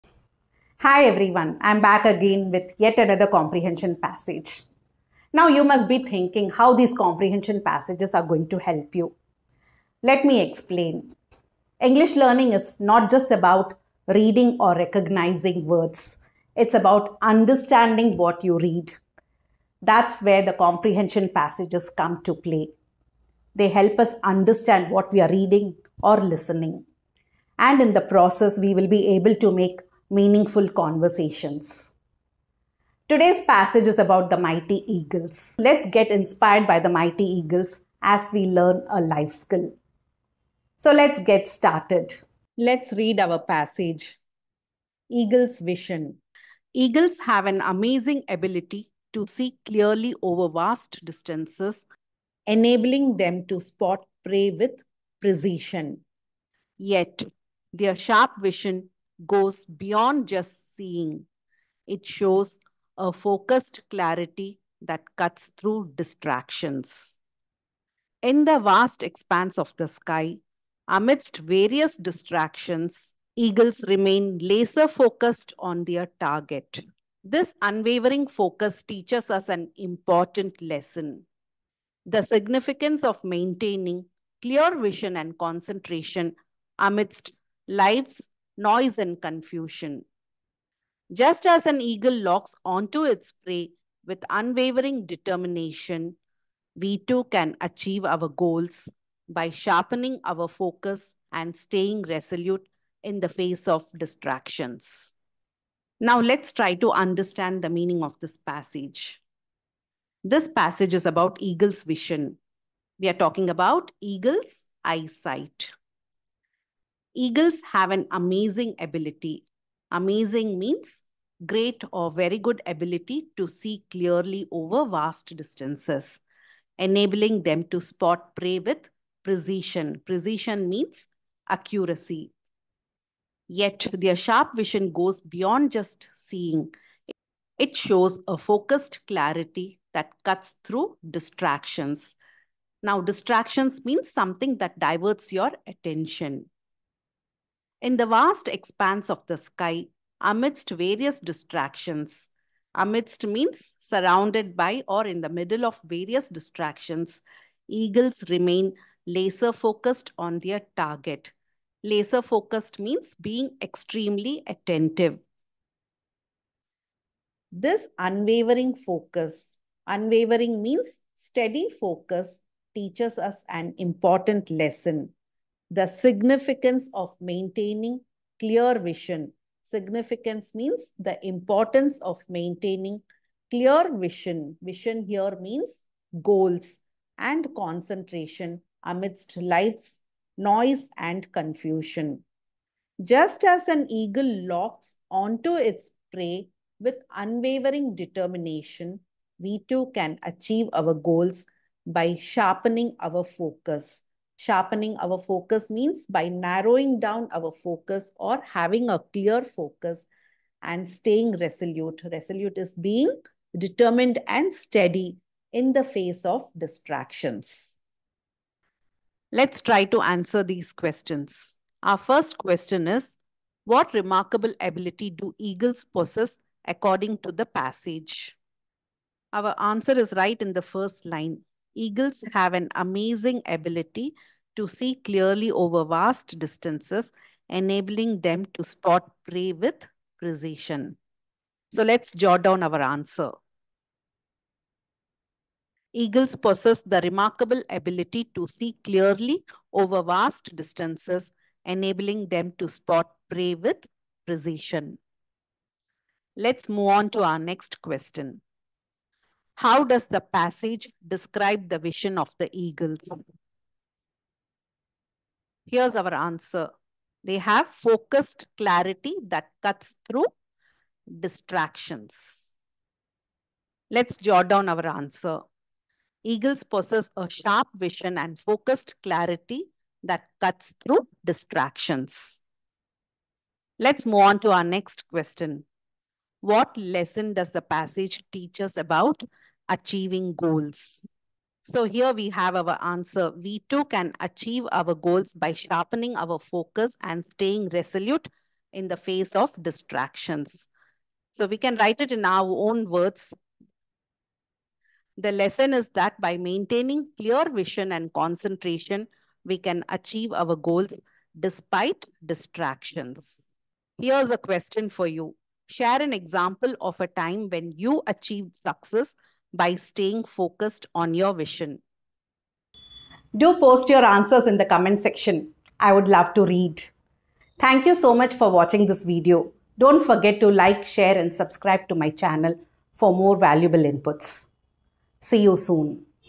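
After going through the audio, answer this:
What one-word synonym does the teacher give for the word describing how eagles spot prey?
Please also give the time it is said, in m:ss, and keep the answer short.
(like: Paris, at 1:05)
Accuracy, at 2:10.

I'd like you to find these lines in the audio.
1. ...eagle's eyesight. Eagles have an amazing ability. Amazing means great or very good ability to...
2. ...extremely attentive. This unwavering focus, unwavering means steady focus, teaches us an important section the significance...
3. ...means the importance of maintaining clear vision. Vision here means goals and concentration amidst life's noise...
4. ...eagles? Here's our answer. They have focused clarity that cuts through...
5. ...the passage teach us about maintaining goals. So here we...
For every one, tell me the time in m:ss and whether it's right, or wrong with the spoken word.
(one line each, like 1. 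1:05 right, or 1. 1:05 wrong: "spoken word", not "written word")
1. 1:54 right
2. 2:43 wrong: "lesson", not "section"
3. 3:00 right
4. 4:22 right
5. 4:47 wrong: "achieving", not "maintaining".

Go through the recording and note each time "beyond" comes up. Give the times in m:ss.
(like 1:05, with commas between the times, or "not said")
0:59, 2:15.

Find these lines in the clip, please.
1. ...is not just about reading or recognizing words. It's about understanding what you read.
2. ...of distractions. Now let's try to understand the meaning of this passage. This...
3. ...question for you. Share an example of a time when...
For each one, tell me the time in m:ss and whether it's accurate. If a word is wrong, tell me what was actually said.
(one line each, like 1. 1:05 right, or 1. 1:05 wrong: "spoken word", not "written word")
1. 0:12 right
2. 1:43 right
3. 5:14 right.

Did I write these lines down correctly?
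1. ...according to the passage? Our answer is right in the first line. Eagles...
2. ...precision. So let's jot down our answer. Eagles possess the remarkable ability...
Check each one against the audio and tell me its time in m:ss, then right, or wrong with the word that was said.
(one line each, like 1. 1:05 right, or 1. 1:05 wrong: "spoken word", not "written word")
1. 3:46 right
2. 4:00 right.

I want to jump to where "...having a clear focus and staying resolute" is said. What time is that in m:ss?
3:28.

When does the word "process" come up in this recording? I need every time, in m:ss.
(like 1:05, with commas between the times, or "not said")
0:28.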